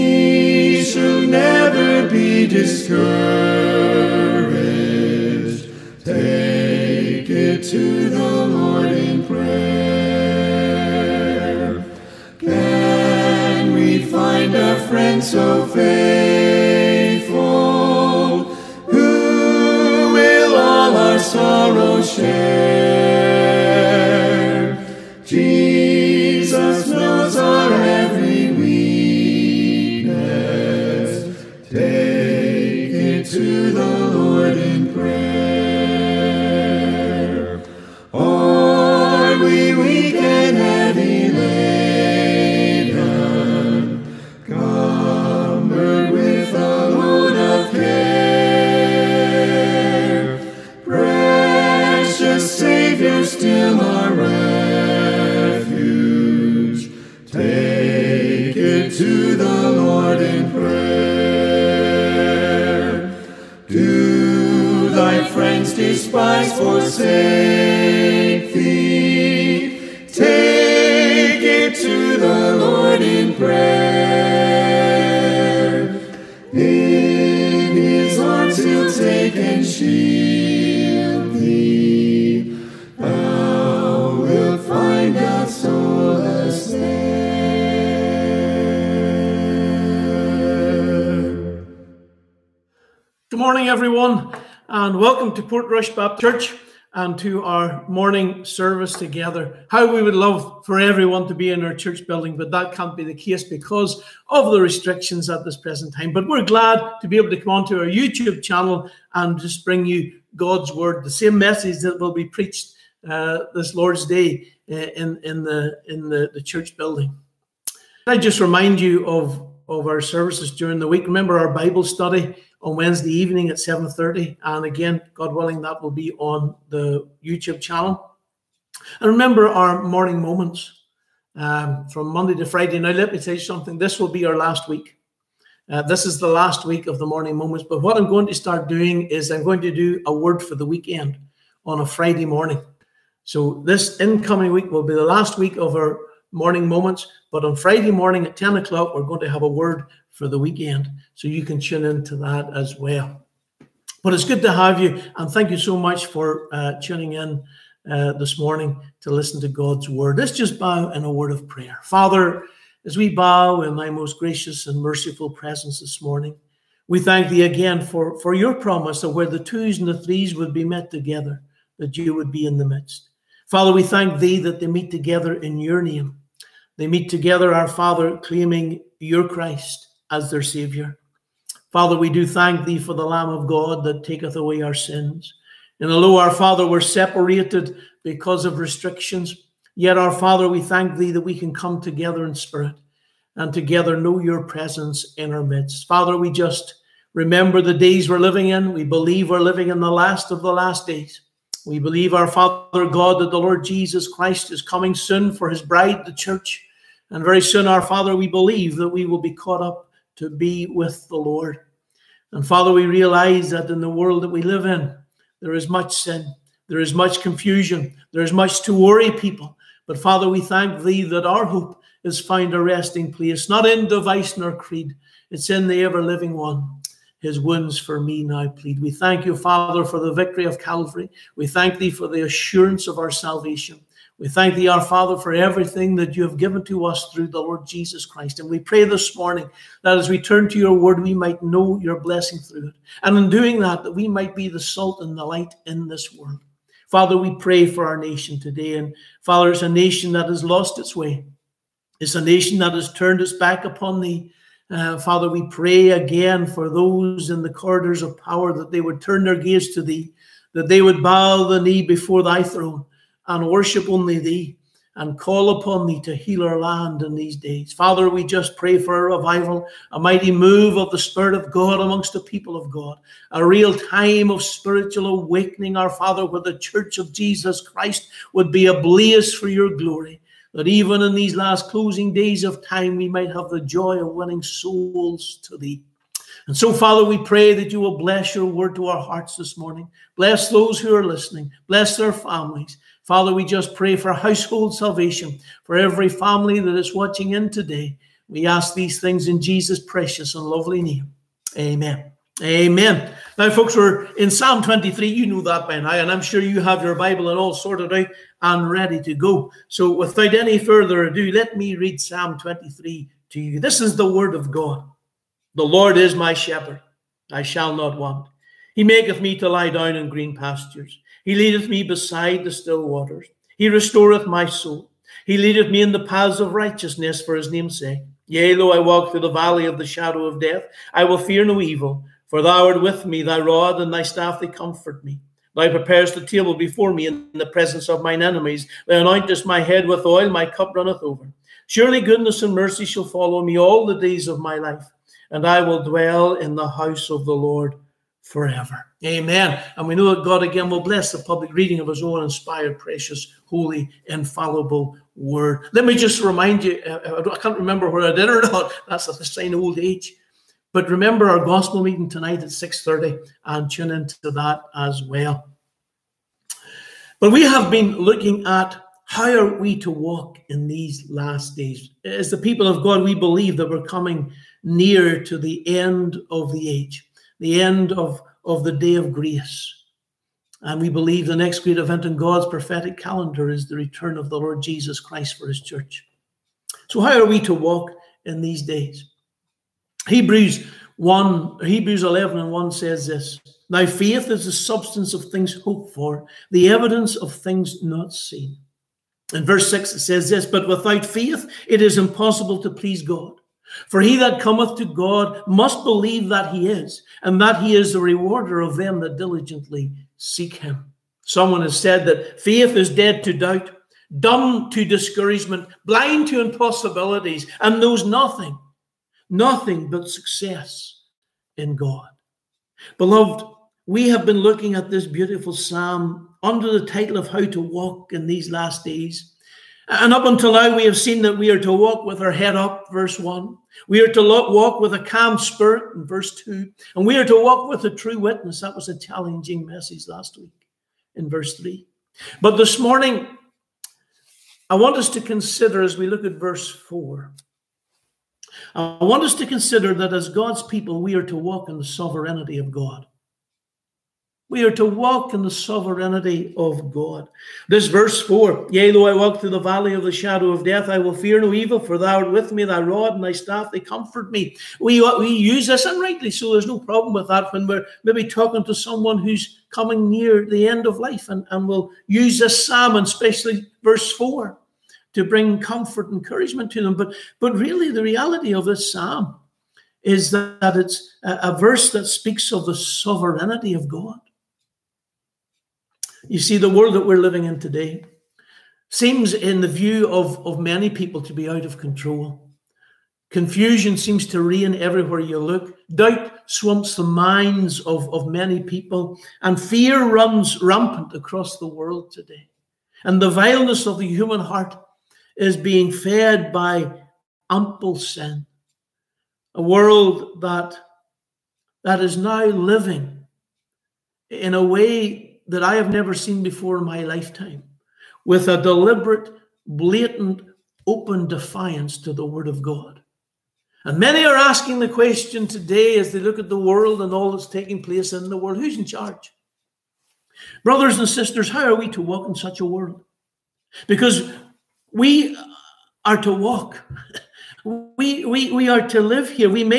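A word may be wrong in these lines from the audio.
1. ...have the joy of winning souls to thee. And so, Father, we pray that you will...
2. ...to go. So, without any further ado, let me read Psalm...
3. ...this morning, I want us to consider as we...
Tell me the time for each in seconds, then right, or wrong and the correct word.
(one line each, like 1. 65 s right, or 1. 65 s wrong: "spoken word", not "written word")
1. 283 s right
2. 309 s right
3. 442 s right.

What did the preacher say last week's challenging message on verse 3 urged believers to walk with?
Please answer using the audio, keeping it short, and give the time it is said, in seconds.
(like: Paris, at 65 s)
A true witness, at 437 s.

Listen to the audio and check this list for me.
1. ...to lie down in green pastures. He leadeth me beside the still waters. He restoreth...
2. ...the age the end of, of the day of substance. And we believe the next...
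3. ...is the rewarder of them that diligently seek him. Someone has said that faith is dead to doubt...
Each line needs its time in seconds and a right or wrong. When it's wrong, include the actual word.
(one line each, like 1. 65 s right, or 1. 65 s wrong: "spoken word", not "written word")
1. 319 s right
2. 376 s wrong: "grace", not "substance"
3. 407 s right.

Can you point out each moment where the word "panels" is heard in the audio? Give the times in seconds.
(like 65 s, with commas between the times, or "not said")
not said.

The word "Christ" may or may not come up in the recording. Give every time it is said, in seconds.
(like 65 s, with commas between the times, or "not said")
179 s, 204 s, 238 s, 277 s, 384 s.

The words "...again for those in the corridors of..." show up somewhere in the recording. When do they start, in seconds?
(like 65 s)
255 s.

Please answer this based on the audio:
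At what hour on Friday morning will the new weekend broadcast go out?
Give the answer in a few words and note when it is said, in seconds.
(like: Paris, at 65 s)
10 o'clock, at 148 s.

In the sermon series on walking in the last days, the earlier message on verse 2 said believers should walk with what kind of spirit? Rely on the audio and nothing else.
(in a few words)
A calm spirit.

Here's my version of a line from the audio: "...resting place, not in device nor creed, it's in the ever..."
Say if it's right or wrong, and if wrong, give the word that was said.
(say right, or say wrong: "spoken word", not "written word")
right.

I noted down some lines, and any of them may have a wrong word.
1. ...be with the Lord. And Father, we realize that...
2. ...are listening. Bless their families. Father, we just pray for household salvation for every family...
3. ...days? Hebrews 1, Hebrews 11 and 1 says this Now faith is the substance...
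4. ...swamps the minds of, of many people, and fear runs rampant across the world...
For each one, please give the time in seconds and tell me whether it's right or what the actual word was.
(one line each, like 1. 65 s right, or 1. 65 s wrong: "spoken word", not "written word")
1. 210 s right
2. 290 s right
3. 388 s right
4. 496 s right.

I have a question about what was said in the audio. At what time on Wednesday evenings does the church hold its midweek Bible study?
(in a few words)
7.30.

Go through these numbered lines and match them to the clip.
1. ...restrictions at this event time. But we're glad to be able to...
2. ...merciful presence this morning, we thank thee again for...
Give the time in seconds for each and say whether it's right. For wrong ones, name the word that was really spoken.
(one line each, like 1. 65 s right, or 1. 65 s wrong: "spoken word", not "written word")
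1. 104 s wrong: "present", not "event"
2. 164 s right.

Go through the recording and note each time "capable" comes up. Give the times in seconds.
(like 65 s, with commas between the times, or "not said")
not said.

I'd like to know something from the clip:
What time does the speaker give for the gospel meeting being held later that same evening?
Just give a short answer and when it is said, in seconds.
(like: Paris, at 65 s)
6.30, at 362 s.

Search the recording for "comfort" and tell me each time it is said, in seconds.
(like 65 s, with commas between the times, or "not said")
334 s, 463 s, 475 s.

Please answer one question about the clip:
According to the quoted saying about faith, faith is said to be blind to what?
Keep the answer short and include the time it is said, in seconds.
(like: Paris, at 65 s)
Impossibilities, at 416 s.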